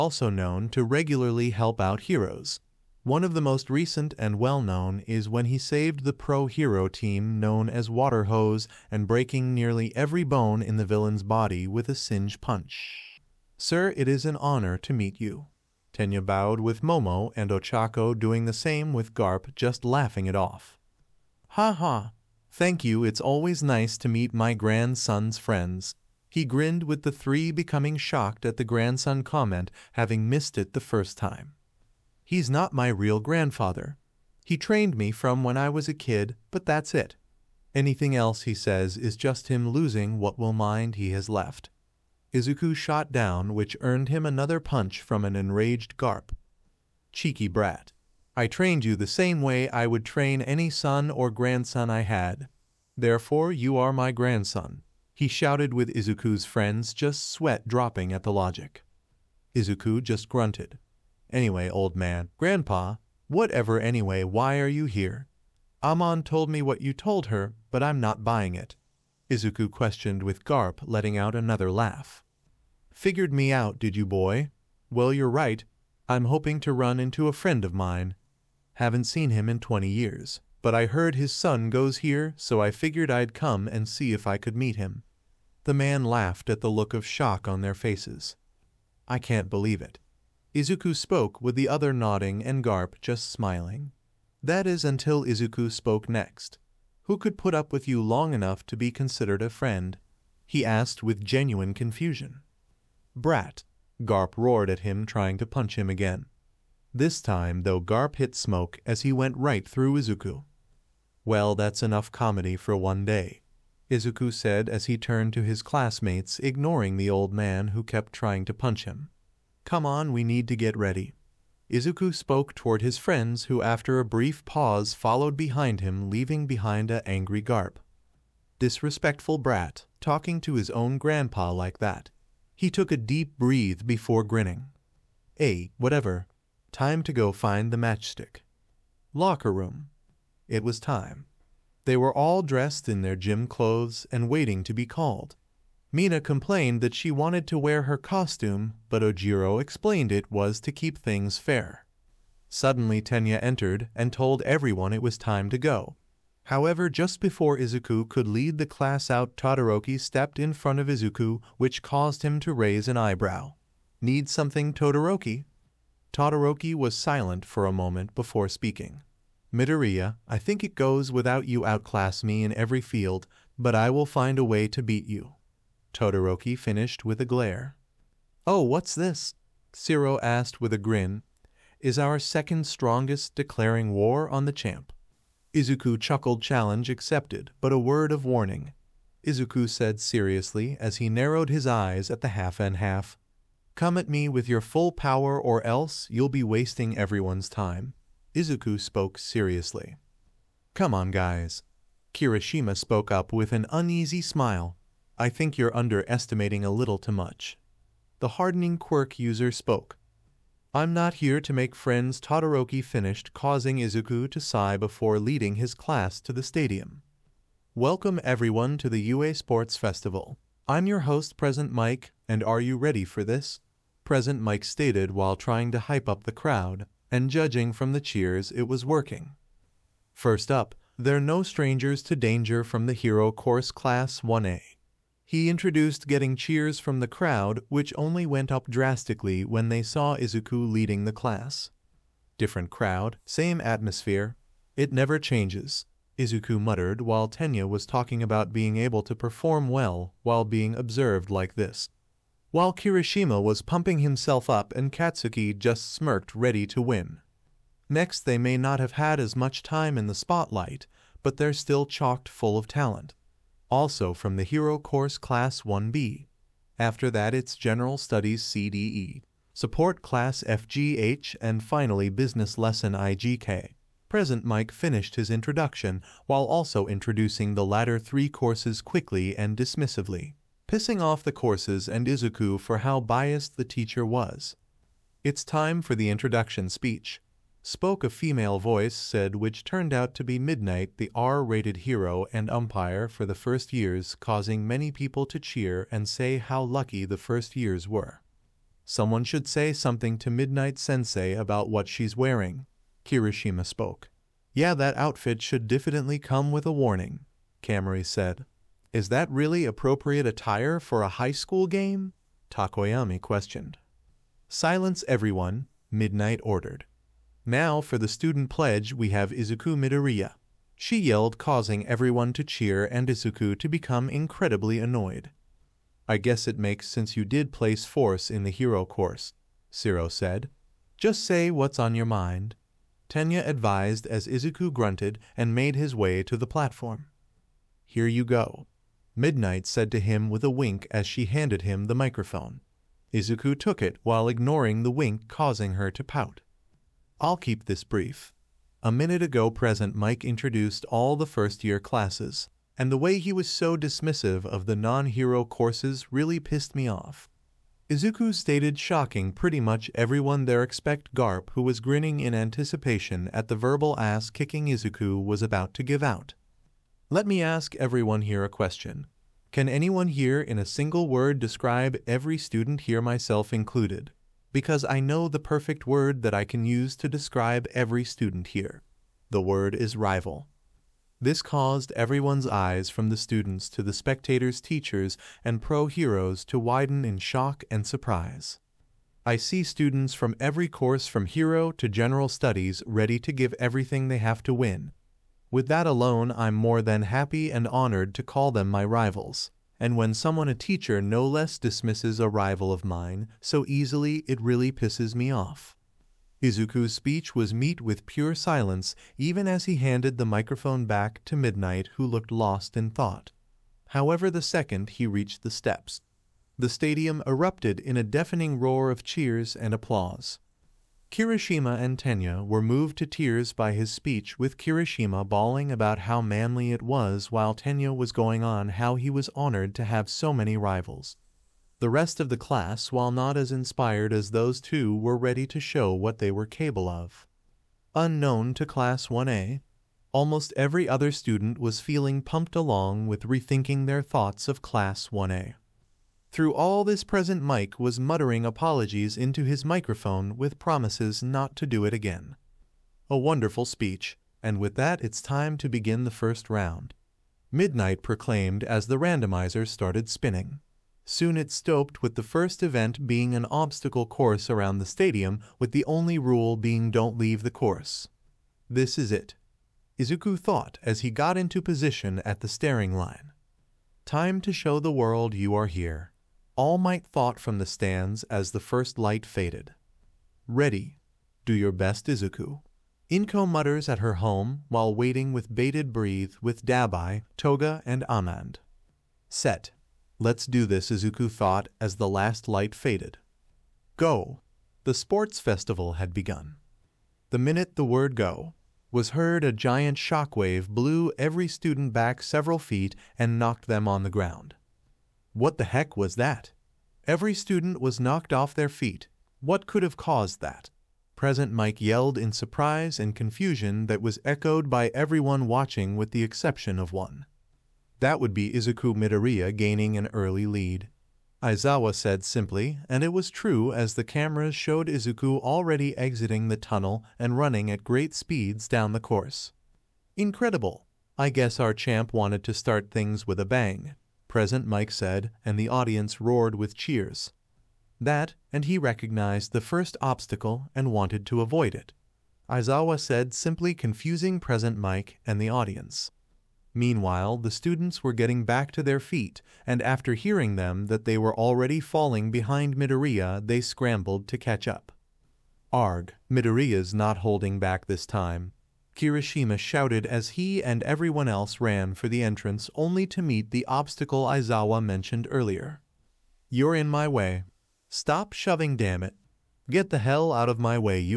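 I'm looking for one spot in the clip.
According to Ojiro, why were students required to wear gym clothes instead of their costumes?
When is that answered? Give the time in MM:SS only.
02:30.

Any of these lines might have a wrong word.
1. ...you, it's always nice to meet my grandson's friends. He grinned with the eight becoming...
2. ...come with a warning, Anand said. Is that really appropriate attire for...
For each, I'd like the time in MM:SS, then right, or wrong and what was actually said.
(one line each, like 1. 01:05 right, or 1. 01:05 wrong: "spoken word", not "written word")
1. 00:22 wrong: "three", not "eight"
2. 05:06 wrong: "Kaminari", not "Anand".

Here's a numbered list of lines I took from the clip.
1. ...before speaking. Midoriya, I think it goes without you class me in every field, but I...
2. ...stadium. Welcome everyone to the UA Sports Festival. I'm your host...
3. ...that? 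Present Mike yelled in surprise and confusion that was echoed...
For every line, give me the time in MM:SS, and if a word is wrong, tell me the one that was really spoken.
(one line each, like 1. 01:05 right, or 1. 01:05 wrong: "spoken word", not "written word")
1. 02:48 wrong: "outclass", not "class"
2. 03:36 right
3. 08:30 right.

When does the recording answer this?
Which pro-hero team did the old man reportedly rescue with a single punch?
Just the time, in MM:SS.
00:07.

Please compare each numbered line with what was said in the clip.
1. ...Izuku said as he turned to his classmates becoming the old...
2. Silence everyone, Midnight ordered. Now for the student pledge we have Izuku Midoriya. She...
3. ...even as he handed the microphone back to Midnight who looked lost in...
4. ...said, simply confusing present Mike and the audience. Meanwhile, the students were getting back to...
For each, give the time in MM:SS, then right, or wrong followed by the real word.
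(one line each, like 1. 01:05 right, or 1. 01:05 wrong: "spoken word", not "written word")
1. 01:53 wrong: "ignoring", not "becoming"
2. 05:14 right
3. 06:49 right
4. 09:03 right.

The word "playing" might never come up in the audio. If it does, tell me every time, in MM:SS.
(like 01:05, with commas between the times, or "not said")
not said.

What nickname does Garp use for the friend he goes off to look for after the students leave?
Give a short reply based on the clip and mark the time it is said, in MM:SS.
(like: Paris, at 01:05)
the matchstick, at 02:17.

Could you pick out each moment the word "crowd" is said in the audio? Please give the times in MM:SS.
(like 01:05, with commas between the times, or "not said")
03:46, 03:57, 04:02.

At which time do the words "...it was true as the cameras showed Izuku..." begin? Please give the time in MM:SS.
08:43.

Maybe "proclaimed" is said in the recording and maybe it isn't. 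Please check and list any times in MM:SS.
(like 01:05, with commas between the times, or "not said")
07:38.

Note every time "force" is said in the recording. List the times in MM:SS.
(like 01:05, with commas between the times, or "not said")
05:27.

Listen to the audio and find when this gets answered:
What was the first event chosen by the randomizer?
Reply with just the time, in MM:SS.
07:43.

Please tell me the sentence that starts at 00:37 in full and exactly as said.
Anything else he says is just him losing what will mind he has left.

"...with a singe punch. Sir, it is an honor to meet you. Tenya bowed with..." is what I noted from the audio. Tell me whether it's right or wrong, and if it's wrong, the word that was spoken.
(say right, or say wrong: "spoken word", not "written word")
right.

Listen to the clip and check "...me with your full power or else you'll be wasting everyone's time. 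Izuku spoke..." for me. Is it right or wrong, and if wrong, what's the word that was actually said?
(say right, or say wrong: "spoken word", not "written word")
right.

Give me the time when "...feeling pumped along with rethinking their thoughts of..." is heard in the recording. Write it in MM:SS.
07:21.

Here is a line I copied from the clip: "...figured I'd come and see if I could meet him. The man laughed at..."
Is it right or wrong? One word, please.
right.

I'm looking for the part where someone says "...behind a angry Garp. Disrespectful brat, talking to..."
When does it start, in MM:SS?
02:06.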